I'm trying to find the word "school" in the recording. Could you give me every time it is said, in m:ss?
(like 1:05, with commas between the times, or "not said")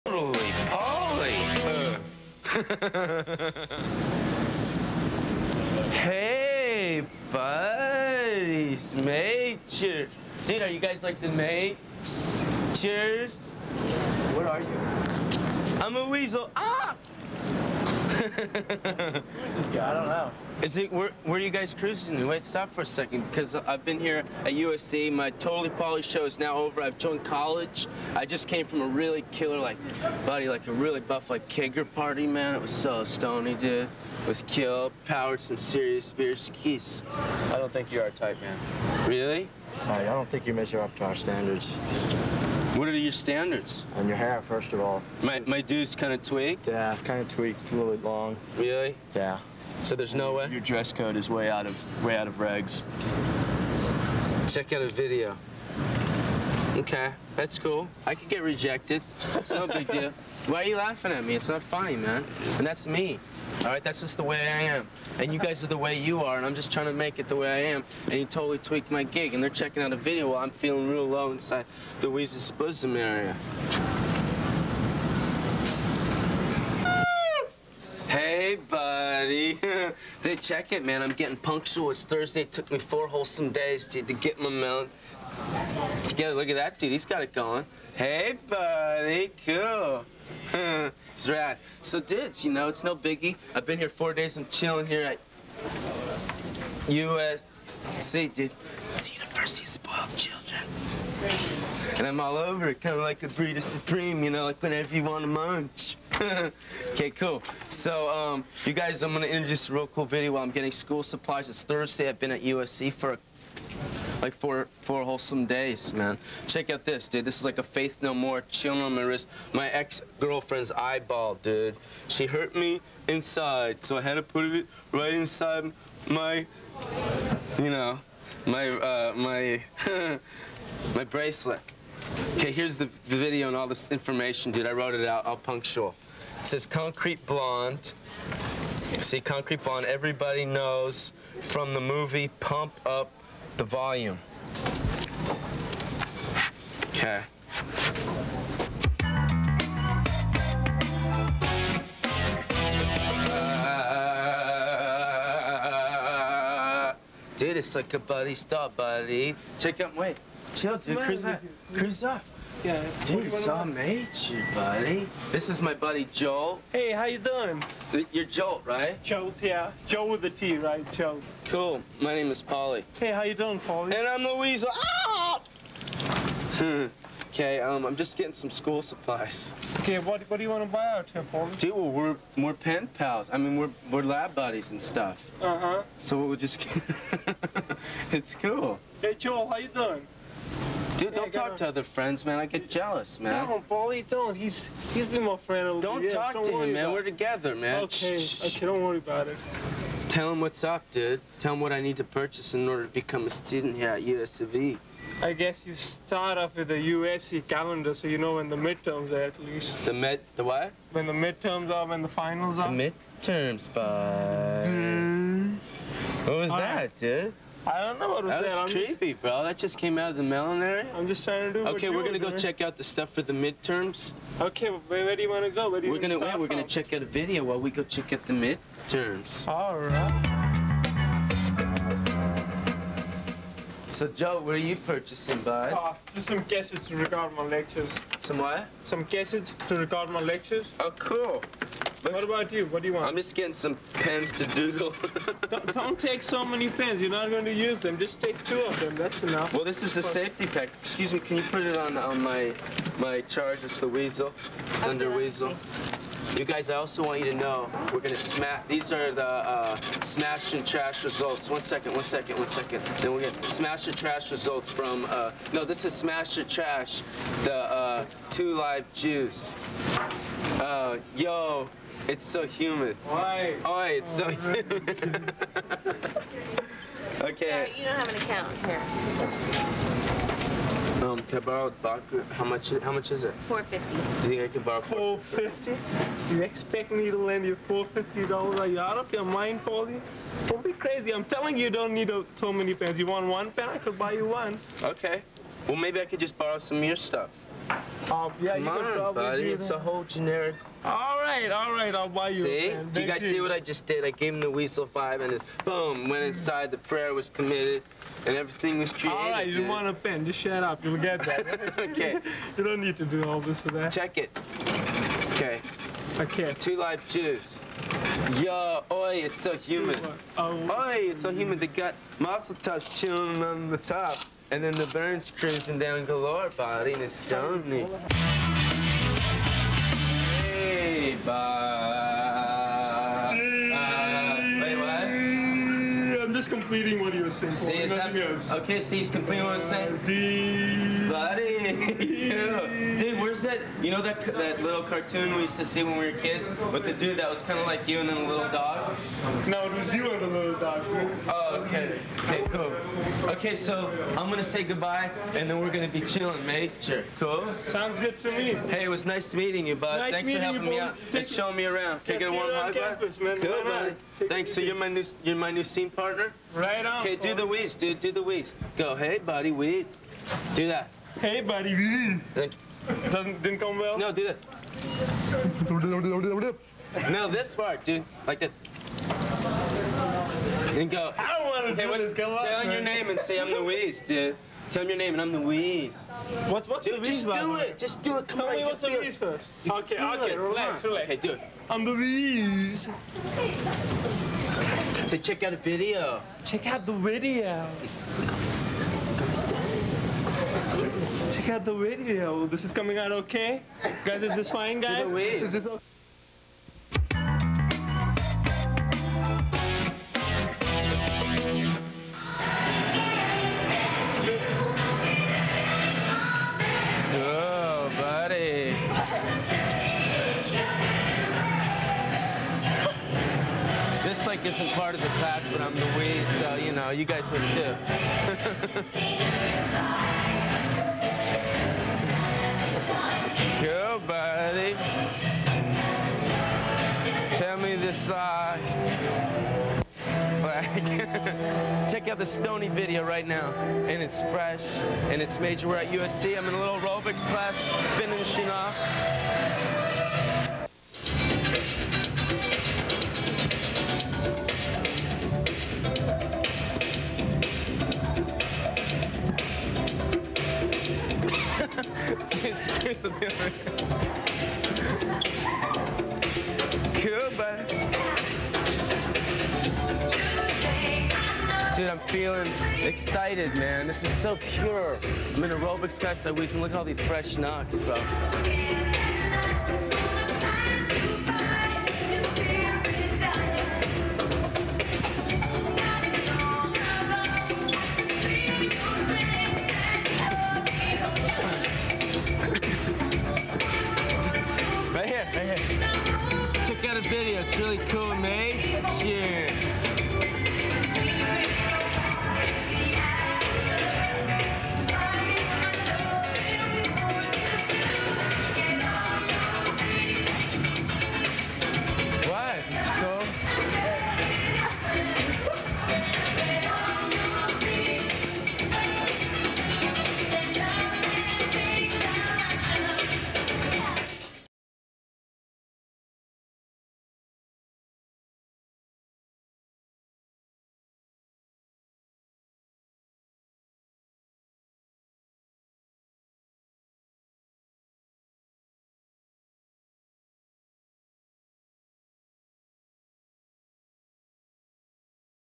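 1:50, 2:58.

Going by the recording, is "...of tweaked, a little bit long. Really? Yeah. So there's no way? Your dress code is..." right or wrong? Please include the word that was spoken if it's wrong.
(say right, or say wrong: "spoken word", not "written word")
right.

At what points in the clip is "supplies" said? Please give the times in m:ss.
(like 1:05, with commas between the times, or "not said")
1:51, 2:58.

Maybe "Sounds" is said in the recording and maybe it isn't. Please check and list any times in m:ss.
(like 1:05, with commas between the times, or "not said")
5:57.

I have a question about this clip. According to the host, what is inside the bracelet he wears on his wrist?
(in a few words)
ex-girlfriend's eyeball.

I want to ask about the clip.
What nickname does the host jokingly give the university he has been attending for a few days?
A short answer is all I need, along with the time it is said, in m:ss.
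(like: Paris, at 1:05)
University of Spoiled Children, at 1:39.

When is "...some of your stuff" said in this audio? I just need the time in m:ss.
4:56.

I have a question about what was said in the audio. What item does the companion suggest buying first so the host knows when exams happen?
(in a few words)
USC calendar.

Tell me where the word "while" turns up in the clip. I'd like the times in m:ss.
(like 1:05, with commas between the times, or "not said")
1:10, 1:50, 3:47.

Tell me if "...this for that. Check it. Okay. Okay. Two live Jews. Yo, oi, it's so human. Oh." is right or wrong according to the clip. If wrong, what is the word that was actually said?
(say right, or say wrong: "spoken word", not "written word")
right.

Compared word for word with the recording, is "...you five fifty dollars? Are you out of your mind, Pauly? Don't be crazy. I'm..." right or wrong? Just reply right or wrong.
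wrong.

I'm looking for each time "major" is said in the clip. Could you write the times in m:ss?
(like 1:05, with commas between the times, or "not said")
0:09, 7:25.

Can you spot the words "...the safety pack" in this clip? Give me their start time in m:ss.
4:09.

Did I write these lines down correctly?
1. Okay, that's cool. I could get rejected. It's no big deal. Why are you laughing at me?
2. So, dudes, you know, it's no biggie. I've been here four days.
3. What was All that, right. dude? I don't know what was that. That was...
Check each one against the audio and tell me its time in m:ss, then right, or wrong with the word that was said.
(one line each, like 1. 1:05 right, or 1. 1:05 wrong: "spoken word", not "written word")
1. 0:56 right
2. 1:31 right
3. 3:36 right.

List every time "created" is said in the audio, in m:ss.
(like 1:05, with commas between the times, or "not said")
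5:08.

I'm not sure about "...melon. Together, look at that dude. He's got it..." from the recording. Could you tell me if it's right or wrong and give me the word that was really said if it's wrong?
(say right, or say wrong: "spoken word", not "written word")
right.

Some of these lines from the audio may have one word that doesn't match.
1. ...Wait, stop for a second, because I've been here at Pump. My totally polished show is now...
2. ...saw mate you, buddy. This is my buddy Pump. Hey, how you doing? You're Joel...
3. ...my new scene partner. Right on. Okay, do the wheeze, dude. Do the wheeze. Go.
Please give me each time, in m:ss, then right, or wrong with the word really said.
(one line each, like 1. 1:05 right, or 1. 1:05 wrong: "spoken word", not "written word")
1. 0:22 wrong: "USC", not "Pump"
2. 2:43 wrong: "Joel", not "Pump"
3. 6:05 right.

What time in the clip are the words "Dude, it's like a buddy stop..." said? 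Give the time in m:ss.
2:37.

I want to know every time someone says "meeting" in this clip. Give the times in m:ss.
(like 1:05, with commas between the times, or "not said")
5:59.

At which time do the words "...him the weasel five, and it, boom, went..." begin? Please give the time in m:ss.
5:04.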